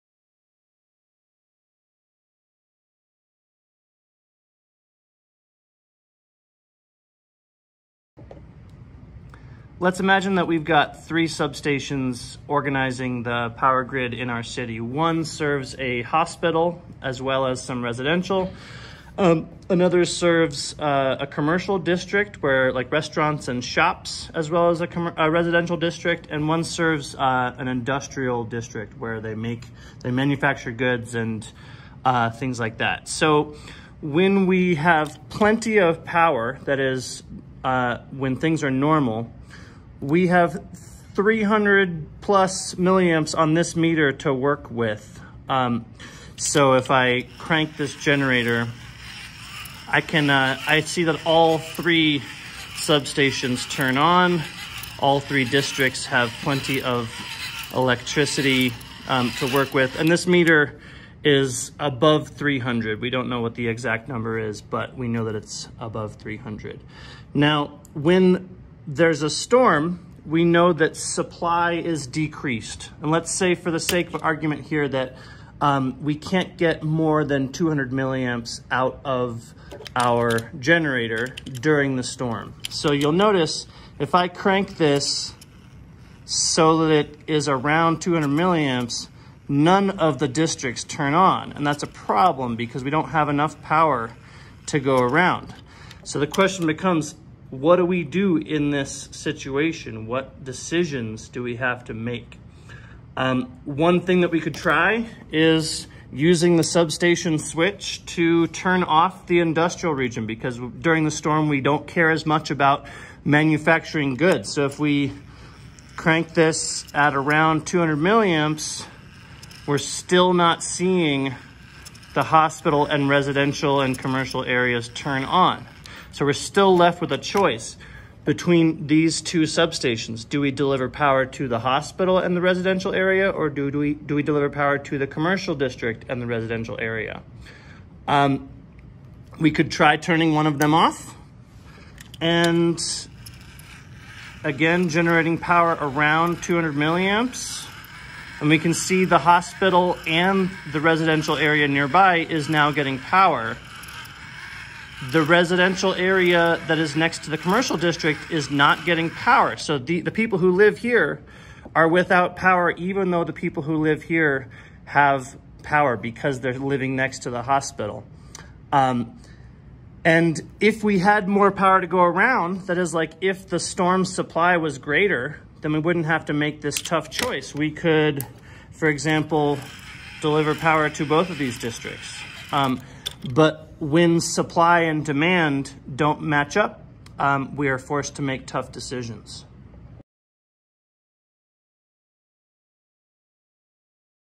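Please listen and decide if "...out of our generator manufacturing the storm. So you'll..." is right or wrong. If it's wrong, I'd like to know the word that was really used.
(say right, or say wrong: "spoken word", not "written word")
wrong: "during", not "manufacturing".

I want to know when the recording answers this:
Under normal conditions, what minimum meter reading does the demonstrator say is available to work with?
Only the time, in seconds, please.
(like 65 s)
41 s.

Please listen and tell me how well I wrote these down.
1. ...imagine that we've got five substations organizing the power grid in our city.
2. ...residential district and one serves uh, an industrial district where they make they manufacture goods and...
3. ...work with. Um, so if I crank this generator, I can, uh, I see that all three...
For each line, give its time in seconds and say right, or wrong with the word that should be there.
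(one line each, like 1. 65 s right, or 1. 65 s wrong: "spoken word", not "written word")
1. 9 s wrong: "three", not "five"
2. 25 s right
3. 44 s right.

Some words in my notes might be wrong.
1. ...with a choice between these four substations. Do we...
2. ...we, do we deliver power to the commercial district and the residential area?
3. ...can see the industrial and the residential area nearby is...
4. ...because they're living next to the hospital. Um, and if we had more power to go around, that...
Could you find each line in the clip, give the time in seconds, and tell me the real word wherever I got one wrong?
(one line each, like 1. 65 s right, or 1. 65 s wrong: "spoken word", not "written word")
1. 126 s wrong: "two", not "four"
2. 133 s right
3. 148 s wrong: "hospital", not "industrial"
4. 165 s right.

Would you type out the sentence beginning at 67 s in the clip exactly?
Now, when there's a storm, we know that supply is decreased.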